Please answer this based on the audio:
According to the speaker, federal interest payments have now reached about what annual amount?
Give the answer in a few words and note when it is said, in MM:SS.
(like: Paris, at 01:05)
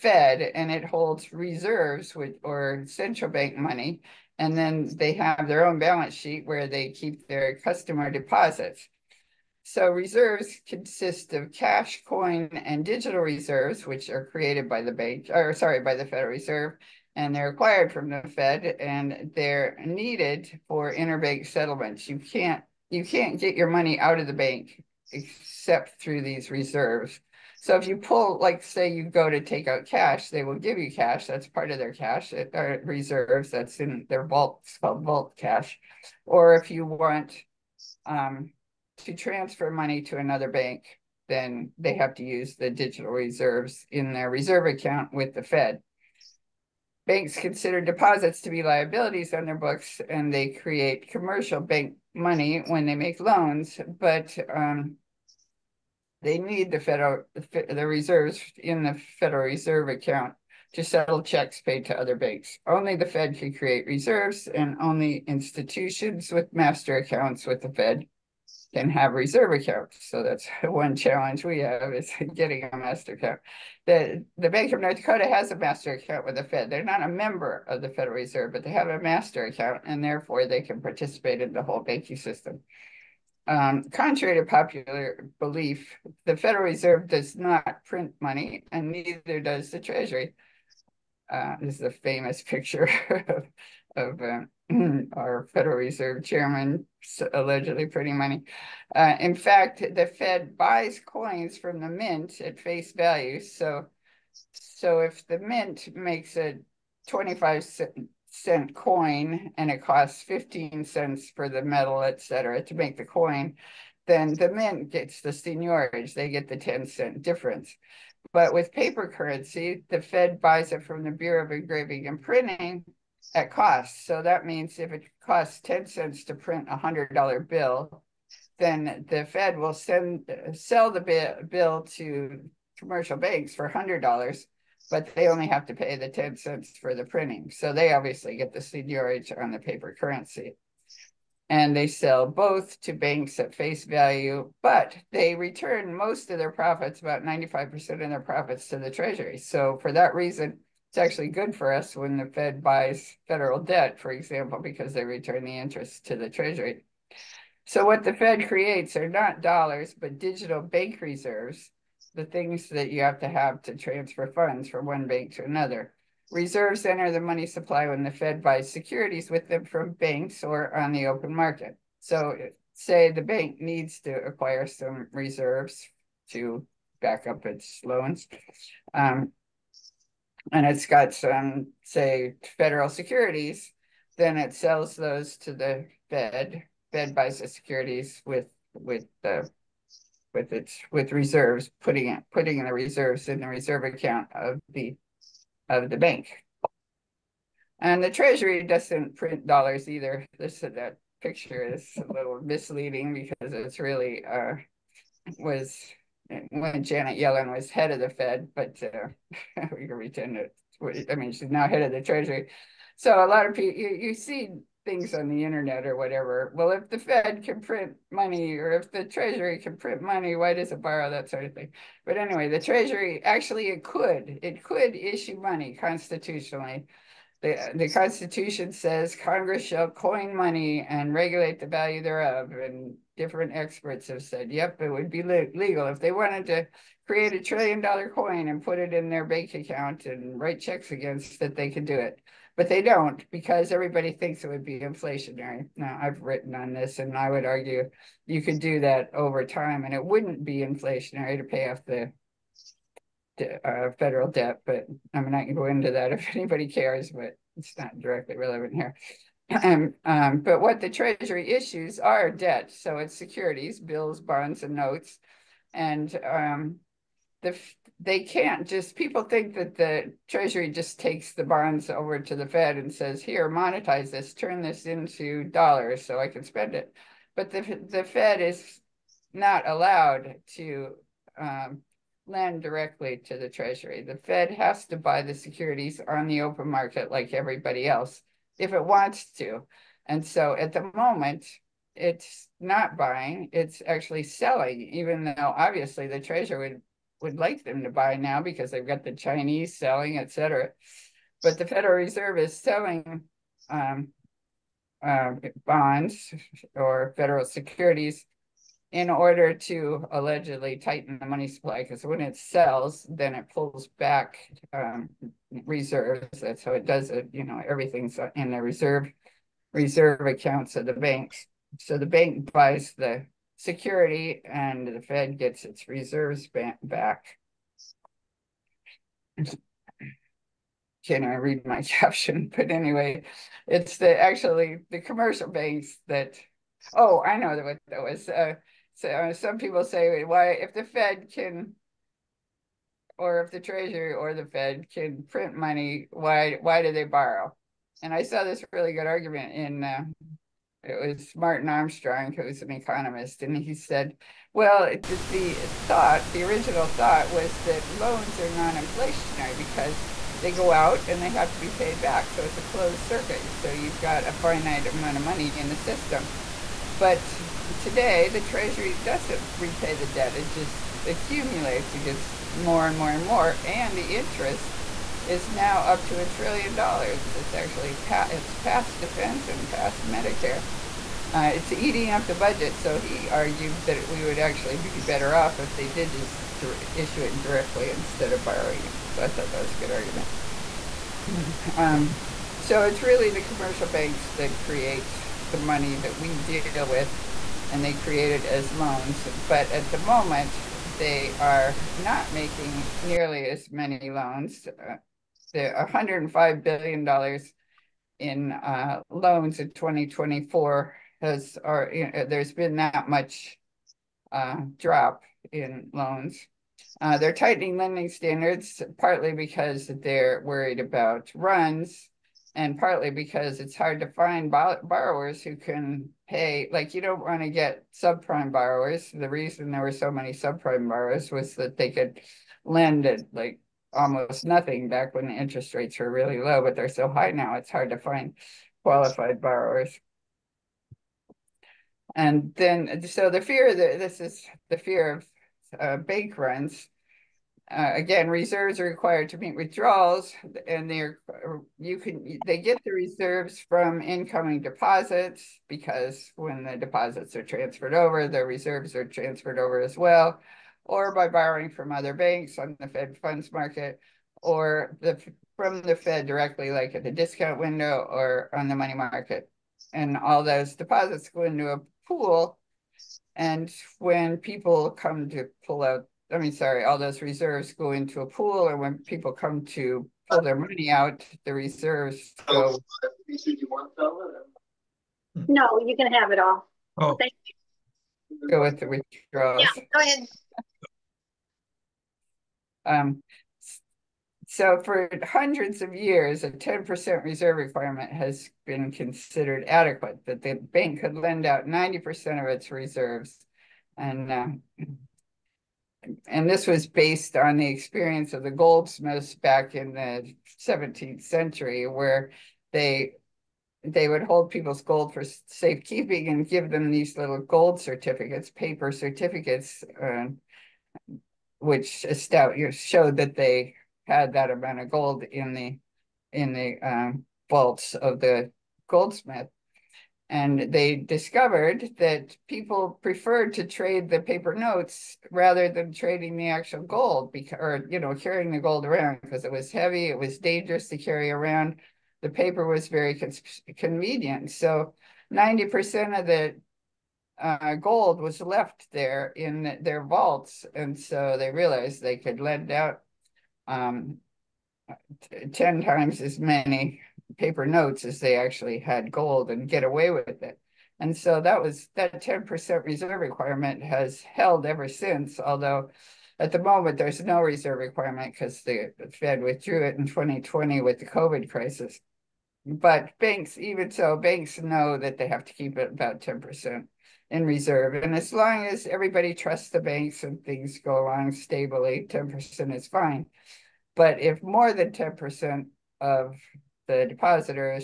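a trillion dollars, at 06:16.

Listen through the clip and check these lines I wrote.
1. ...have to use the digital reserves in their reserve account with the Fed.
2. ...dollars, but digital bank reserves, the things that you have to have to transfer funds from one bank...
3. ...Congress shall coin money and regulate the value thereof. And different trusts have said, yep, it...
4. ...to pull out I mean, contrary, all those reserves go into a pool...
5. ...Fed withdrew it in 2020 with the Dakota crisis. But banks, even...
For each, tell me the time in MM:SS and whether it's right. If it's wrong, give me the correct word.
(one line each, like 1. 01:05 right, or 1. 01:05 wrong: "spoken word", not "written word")
1. 00:41 right
2. 02:39 right
3. 03:49 wrong: "experts", not "trusts"
4. 07:55 wrong: "sorry", not "contrary"
5. 09:29 wrong: "COVID", not "Dakota".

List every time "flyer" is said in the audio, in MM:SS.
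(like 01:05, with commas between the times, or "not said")
not said.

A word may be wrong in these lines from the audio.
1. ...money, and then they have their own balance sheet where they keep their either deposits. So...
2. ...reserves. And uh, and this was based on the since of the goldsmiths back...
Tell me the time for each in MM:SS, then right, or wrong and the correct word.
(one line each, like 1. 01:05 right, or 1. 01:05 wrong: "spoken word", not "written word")
1. 00:03 wrong: "customer", not "either"
2. 08:22 wrong: "experience", not "since".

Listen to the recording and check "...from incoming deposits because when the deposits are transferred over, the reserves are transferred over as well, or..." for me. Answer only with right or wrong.
right.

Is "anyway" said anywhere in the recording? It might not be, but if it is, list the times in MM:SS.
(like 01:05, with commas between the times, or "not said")
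03:42, 05:32.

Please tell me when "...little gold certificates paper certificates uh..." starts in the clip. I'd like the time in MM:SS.
08:37.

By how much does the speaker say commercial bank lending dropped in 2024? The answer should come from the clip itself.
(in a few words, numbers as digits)
$105 billion.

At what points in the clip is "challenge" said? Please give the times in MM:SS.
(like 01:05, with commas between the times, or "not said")
01:10.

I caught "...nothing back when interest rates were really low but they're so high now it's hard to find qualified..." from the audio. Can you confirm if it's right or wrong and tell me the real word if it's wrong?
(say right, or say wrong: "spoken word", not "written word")
right.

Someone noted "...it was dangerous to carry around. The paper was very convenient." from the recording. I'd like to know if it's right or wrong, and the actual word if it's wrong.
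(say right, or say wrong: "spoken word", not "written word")
right.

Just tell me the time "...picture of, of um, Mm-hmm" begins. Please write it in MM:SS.
01:32.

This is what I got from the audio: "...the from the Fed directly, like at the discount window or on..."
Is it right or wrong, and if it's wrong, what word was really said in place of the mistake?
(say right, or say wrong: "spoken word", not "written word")
right.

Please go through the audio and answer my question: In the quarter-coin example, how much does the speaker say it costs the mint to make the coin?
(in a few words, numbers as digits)
15 cents.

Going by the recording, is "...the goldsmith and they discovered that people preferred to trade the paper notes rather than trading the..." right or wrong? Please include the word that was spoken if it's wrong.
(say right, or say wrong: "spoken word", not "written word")
right.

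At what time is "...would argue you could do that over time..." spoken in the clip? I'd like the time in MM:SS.
04:07.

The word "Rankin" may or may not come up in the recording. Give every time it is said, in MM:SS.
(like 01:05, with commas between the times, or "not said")
not said.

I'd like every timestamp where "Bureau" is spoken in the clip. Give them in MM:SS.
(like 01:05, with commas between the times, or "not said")
02:01.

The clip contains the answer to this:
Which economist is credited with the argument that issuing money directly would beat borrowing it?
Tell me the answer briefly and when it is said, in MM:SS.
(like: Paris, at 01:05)
Martin Armstrong, at 05:51.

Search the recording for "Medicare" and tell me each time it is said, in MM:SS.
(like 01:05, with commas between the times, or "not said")
06:20.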